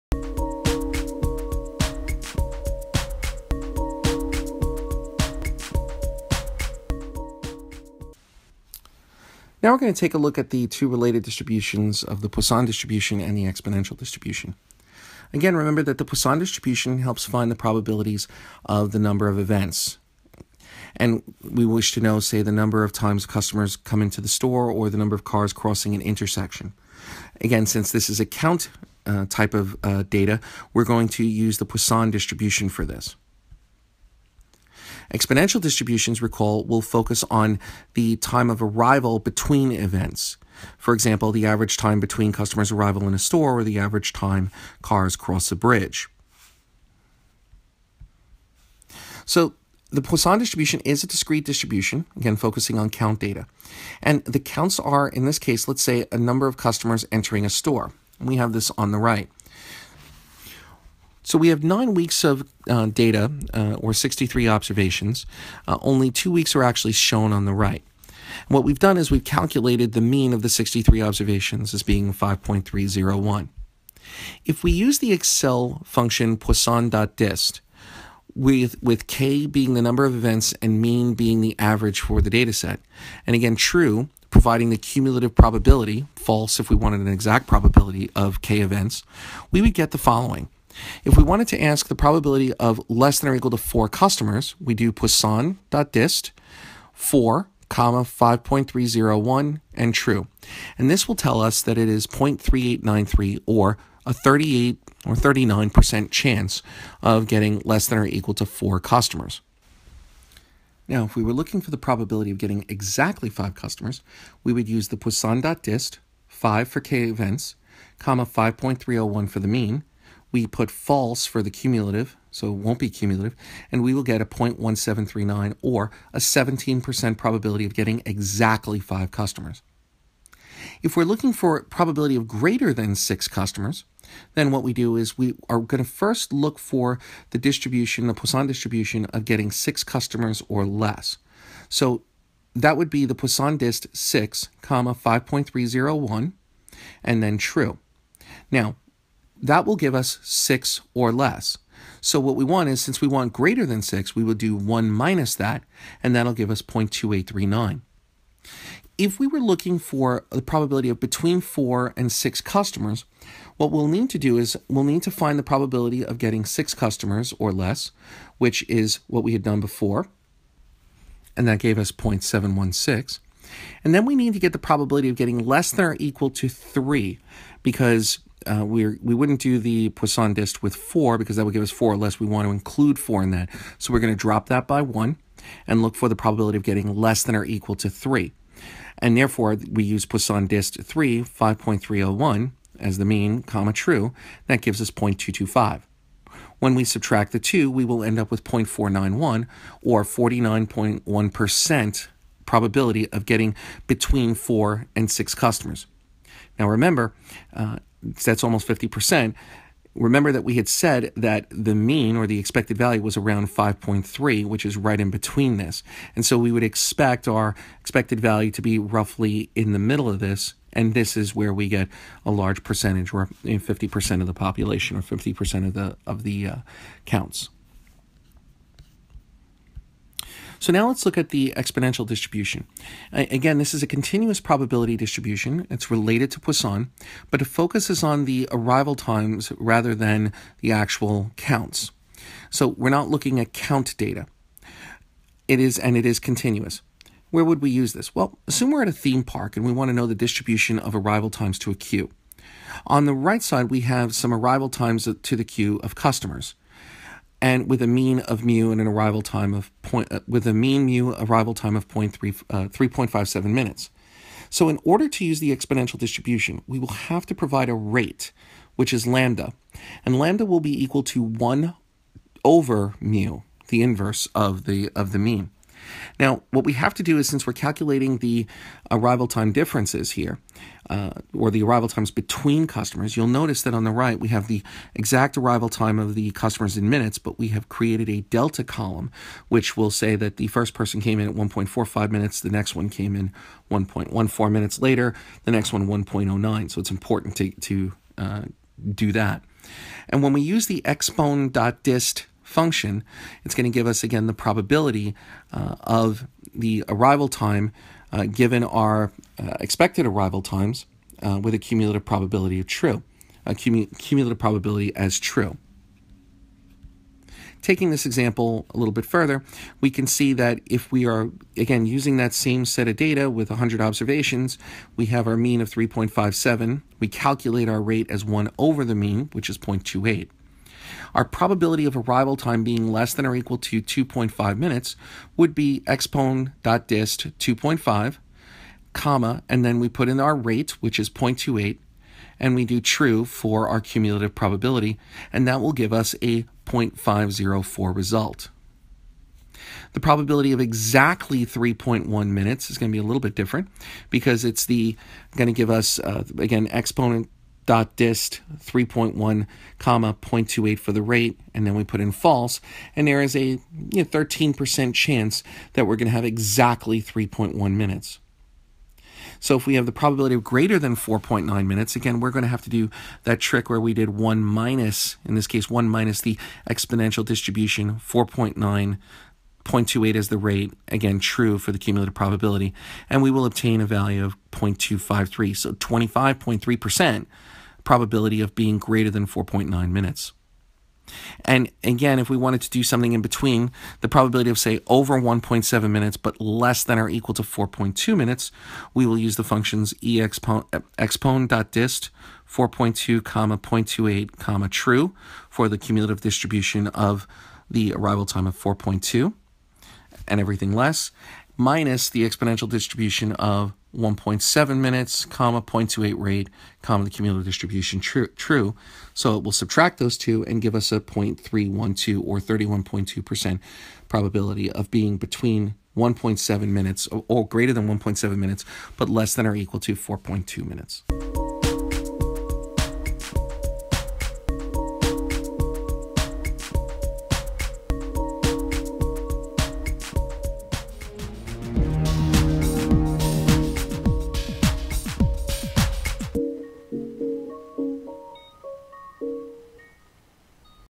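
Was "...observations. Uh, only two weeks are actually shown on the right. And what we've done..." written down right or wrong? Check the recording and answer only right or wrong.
right.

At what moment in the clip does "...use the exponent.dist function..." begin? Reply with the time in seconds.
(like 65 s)
300 s.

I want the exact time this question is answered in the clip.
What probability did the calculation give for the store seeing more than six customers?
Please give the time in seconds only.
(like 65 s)
156 s.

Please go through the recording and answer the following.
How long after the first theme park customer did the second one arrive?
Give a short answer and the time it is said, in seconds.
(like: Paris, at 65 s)
1.14 minutes, at 293 s.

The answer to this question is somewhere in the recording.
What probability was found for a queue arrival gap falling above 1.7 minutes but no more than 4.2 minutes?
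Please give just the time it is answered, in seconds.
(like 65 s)
421 s.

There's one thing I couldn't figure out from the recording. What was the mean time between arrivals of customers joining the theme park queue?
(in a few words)
3.57 minutes.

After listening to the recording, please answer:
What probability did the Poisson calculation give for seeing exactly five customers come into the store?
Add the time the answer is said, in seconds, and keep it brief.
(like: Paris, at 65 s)
0.1739, at 124 s.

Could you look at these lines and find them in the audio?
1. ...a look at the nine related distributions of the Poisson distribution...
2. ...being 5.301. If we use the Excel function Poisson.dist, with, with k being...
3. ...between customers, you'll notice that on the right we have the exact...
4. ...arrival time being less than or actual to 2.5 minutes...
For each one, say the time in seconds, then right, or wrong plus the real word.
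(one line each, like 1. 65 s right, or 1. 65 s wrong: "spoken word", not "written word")
1. 10 s wrong: "two", not "nine"
2. 71 s right
3. 282 s right
4. 331 s wrong: "equal", not "actual".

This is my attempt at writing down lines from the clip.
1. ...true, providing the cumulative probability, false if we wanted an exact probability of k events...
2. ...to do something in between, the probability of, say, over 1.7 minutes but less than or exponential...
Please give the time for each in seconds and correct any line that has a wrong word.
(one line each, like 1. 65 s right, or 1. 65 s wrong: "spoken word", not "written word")
1. 83 s right
2. 392 s wrong: "equal", not "exponential".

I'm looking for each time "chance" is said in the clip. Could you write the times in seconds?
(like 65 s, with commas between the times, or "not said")
106 s, 364 s.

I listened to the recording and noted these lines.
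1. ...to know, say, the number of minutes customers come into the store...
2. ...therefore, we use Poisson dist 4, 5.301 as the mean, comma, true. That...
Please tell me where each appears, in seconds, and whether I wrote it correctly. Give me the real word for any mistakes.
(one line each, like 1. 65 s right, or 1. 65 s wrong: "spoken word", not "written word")
1. 21 s wrong: "times", not "minutes"
2. 189 s wrong: "3", not "4".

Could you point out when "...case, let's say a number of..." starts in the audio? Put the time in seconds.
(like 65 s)
55 s.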